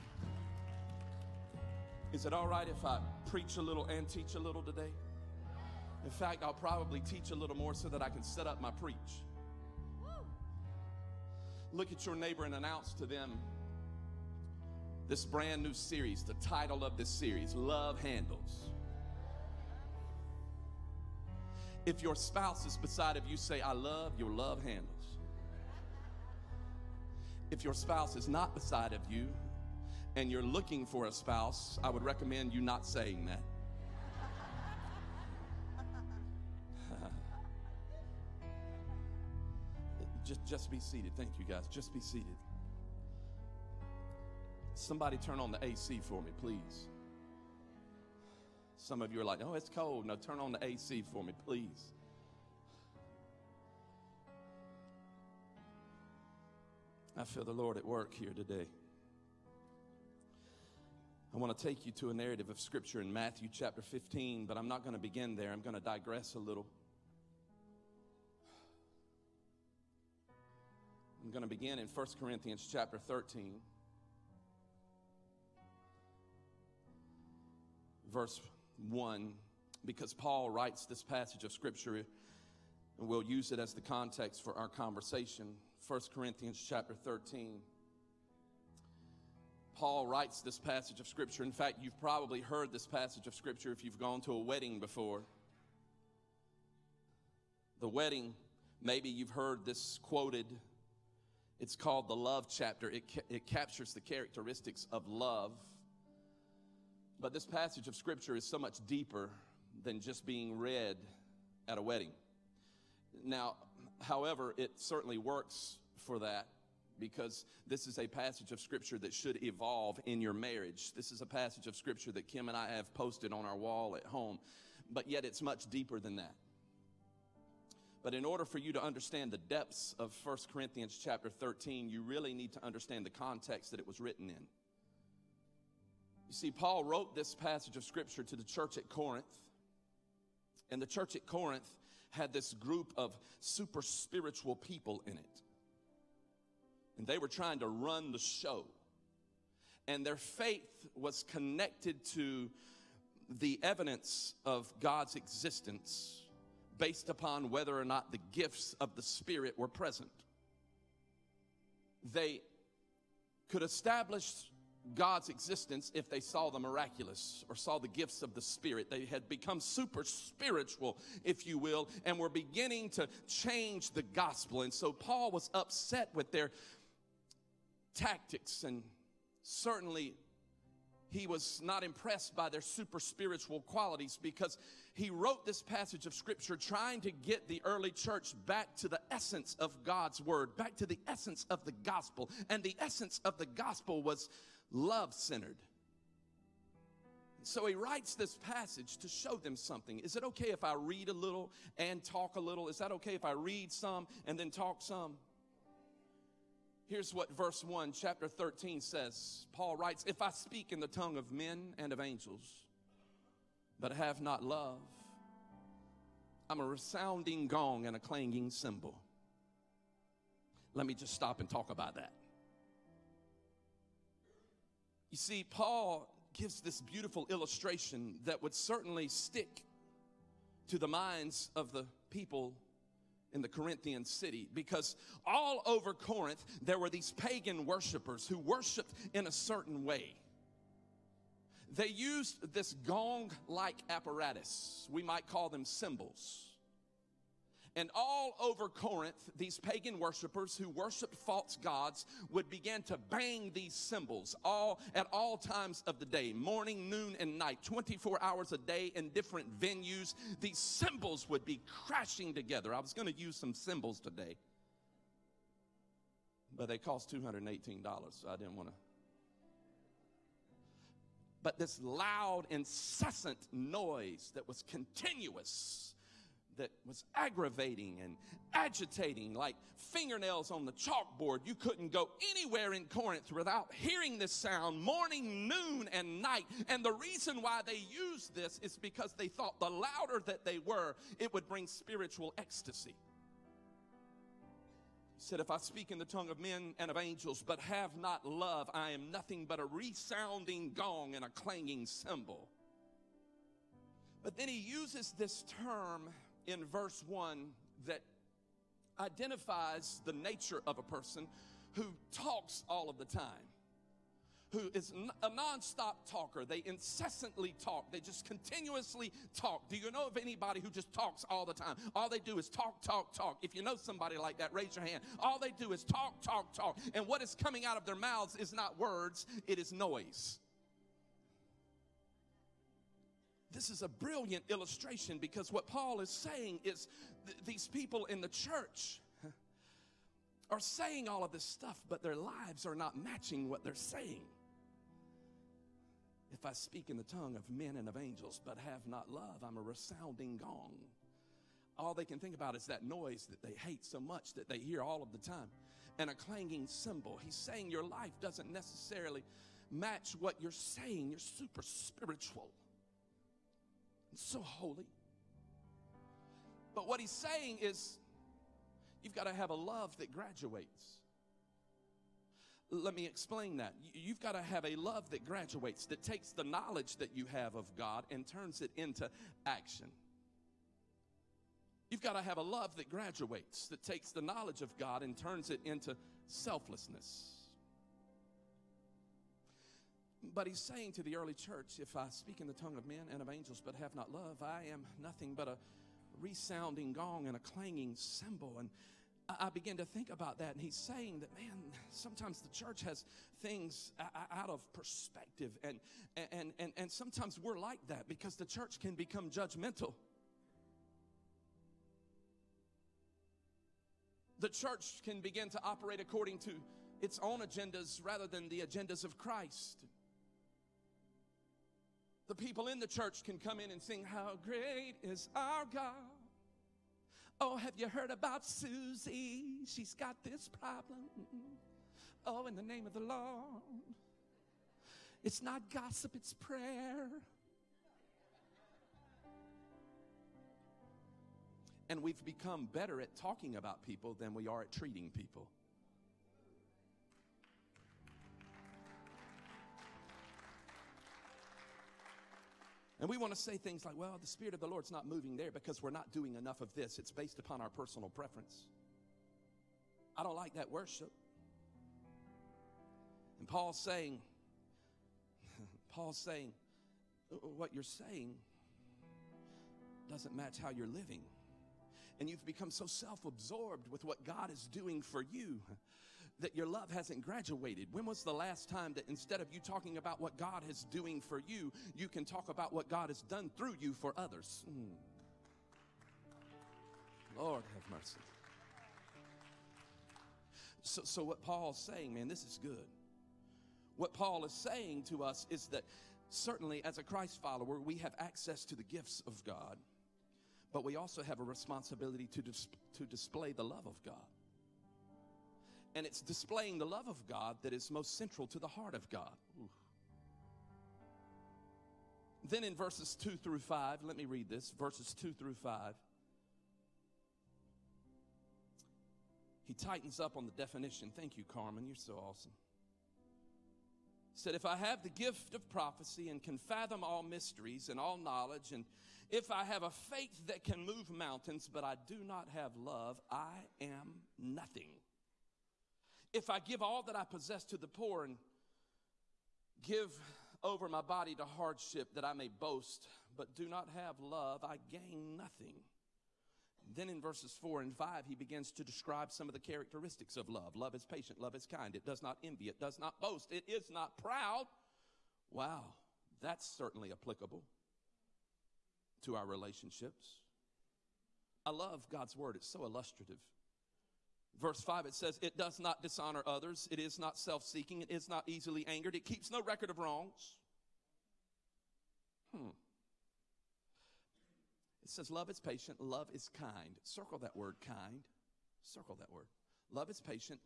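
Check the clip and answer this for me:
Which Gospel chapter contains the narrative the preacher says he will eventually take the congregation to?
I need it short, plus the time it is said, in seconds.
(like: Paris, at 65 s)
Matthew 15, at 63 s.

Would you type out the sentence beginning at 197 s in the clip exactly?
So he writes this passage to show them something.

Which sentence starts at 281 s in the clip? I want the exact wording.
You couldn't go anywhere in Corinth without hearing this sound morning, noon, and night.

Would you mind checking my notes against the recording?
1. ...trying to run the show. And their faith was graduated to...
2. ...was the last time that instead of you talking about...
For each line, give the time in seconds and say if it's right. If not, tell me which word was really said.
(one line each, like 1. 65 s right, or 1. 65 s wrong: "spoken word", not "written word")
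1. 147 s wrong: "connected", not "graduated"
2. 478 s right.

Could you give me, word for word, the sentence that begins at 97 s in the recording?
The wedding, maybe you've heard this quoted.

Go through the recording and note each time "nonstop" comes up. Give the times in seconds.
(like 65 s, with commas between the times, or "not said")
315 s.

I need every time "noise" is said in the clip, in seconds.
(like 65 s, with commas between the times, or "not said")
273 s, 329 s, 352 s.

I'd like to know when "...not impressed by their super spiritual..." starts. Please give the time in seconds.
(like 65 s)
181 s.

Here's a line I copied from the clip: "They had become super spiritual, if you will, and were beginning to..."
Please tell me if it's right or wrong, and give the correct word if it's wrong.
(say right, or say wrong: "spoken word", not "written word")
right.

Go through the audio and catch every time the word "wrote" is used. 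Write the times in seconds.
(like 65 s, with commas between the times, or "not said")
136 s, 185 s.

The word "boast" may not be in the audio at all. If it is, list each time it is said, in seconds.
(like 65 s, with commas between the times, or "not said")
542 s, 553 s.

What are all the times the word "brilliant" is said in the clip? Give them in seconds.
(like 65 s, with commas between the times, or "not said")
333 s.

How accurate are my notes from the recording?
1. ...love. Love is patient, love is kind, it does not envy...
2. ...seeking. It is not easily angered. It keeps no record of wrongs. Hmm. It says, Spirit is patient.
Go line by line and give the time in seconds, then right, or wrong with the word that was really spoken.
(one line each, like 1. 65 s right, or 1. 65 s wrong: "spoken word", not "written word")
1. 550 s right
2. 567 s wrong: "Love", not "Spirit".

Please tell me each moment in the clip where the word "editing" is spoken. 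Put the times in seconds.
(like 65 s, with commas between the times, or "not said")
not said.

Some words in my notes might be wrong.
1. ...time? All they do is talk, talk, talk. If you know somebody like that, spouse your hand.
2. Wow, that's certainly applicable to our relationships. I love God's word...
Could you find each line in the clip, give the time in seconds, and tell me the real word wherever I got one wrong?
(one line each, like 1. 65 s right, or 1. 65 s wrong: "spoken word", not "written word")
1. 321 s wrong: "raise", not "spouse"
2. 555 s right.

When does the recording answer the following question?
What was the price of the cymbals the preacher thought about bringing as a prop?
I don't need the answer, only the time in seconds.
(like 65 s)
267 s.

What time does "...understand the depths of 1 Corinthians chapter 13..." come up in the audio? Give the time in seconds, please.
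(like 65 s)
128 s.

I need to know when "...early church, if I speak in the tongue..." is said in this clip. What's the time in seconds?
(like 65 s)
391 s.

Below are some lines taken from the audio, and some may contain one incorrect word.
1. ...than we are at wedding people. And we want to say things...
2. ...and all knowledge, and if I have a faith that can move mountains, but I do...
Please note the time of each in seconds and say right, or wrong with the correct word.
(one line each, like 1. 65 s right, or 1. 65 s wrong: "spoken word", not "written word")
1. 444 s wrong: "treating", not "wedding"
2. 527 s right.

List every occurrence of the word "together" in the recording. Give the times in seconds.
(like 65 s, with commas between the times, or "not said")
262 s.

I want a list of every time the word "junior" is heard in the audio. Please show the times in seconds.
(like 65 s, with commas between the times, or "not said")
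not said.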